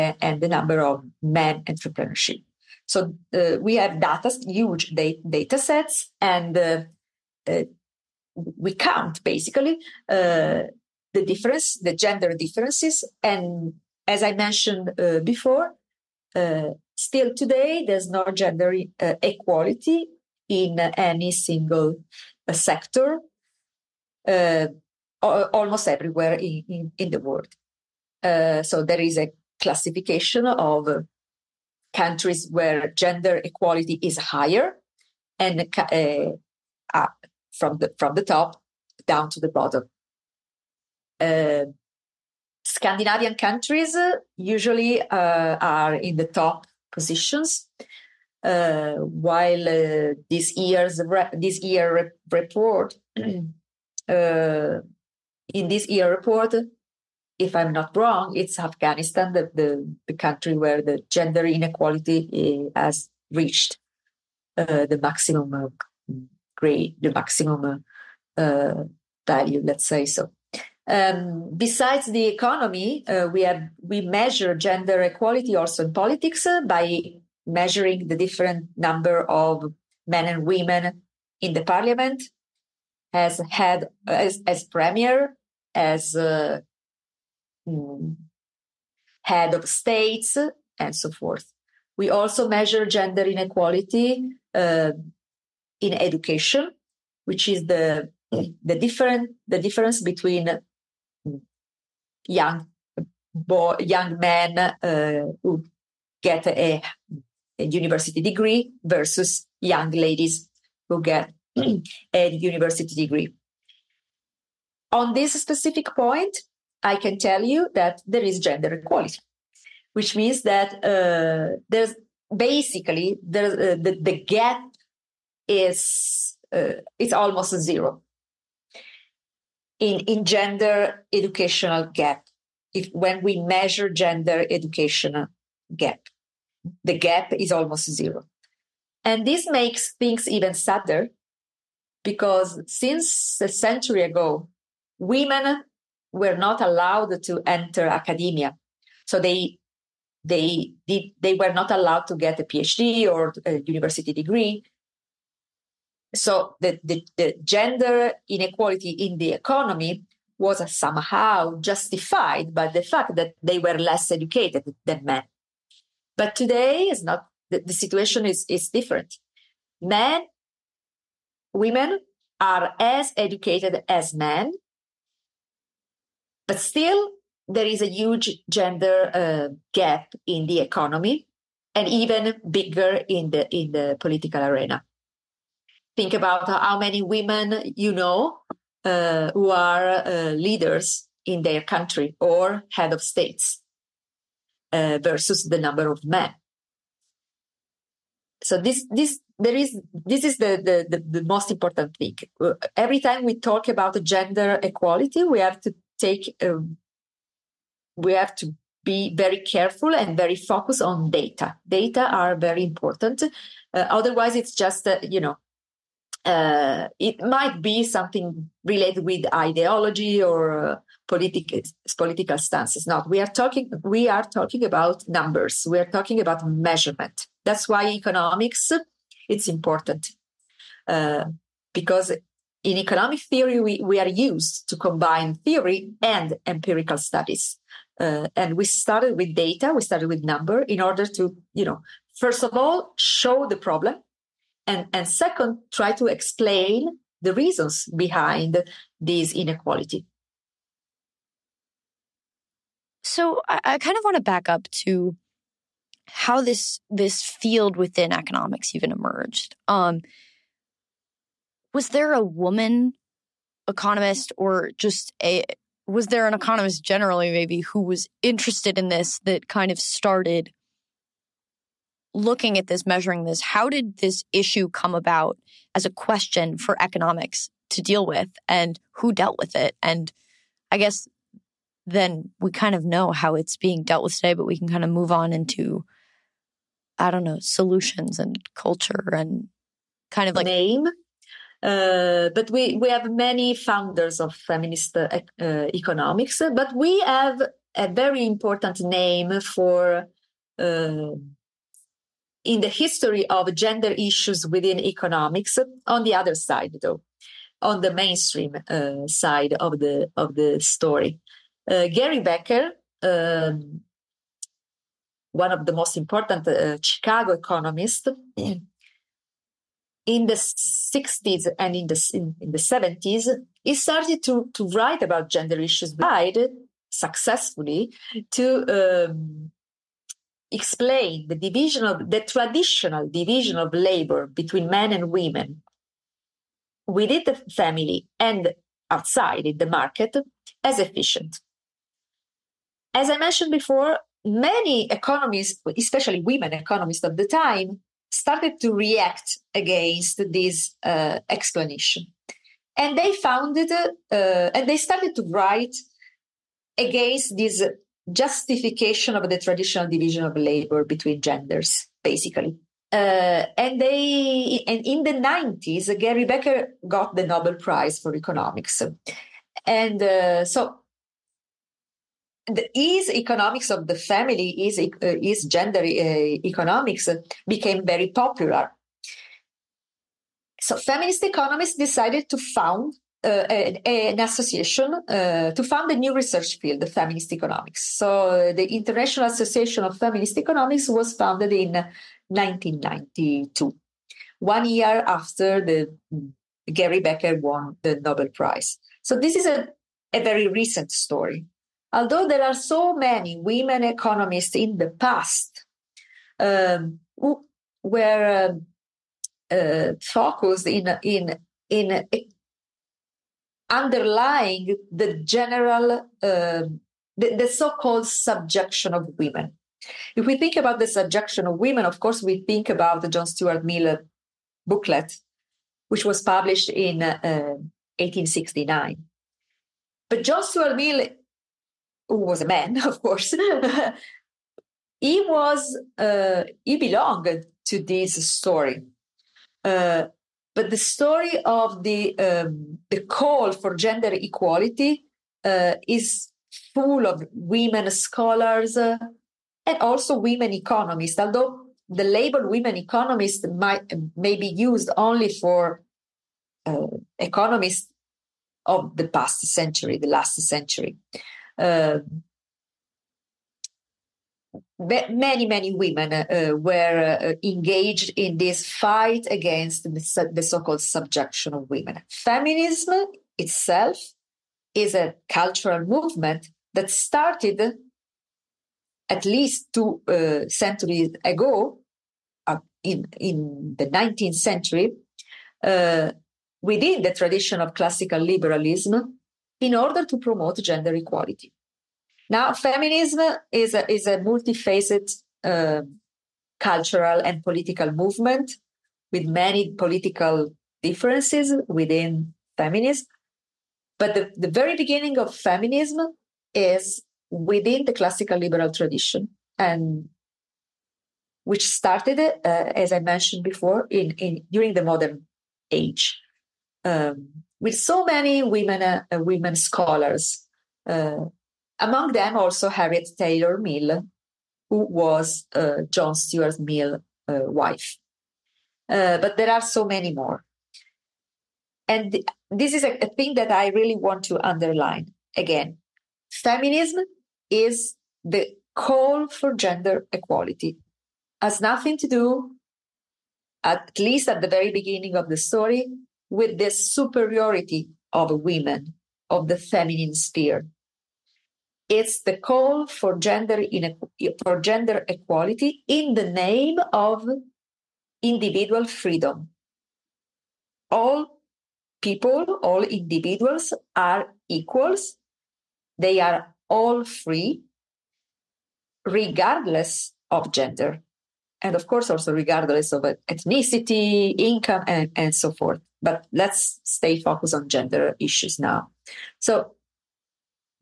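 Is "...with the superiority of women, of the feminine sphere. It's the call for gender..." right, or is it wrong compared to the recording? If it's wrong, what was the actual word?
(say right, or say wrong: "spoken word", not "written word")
right.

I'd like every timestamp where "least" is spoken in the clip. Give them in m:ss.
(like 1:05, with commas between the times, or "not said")
7:59, 9:03.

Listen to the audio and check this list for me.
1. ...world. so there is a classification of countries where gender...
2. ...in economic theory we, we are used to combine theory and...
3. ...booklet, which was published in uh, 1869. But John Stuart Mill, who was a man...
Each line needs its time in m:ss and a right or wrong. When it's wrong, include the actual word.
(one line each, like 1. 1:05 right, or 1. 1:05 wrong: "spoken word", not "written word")
1. 0:27 right
2. 3:52 right
3. 7:04 right.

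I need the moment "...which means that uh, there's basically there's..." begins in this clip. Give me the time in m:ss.
1:59.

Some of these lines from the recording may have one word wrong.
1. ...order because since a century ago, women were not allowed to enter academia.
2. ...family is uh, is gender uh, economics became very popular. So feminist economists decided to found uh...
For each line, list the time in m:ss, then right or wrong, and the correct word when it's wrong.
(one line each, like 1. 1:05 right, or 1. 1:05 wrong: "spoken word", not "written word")
1. 2:20 wrong: "sadder", not "order"
2. 6:13 right.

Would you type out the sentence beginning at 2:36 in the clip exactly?
So the, the, the gender inequality in the economy was somehow justified by the fact that they were less educated than men.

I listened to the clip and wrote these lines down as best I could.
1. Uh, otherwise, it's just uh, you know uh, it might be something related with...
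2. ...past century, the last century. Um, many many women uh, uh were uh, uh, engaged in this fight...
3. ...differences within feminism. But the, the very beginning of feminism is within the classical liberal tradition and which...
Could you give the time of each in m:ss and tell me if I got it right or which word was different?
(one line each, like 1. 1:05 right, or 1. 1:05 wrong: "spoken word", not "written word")
1. 3:33 right
2. 7:39 right
3. 8:20 right.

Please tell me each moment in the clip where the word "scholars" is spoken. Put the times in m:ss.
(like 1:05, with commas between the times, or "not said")
7:27, 8:39.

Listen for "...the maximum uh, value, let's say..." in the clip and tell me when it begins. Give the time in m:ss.
1:07.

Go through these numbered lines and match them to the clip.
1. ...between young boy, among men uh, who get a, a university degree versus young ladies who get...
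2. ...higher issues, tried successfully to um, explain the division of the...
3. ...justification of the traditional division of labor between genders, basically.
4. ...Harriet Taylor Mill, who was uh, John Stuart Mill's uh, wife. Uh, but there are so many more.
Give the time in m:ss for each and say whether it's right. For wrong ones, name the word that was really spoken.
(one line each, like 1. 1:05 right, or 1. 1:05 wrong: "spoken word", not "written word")
1. 1:40 wrong: "young", not "among"
2. 5:25 wrong: "gender", not "higher"
3. 5:58 right
4. 8:42 right.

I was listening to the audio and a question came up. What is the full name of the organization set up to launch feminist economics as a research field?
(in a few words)
International Association of Feminist Economics.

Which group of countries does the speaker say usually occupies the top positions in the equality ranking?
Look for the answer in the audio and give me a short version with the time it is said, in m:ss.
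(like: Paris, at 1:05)
Scandinavian countries, at 0:42.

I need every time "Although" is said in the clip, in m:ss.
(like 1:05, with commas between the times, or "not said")
6:41, 7:31.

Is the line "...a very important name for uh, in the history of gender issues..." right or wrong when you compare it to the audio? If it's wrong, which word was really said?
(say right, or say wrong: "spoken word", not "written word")
right.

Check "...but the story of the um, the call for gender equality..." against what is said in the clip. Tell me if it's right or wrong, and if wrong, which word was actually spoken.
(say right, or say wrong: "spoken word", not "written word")
right.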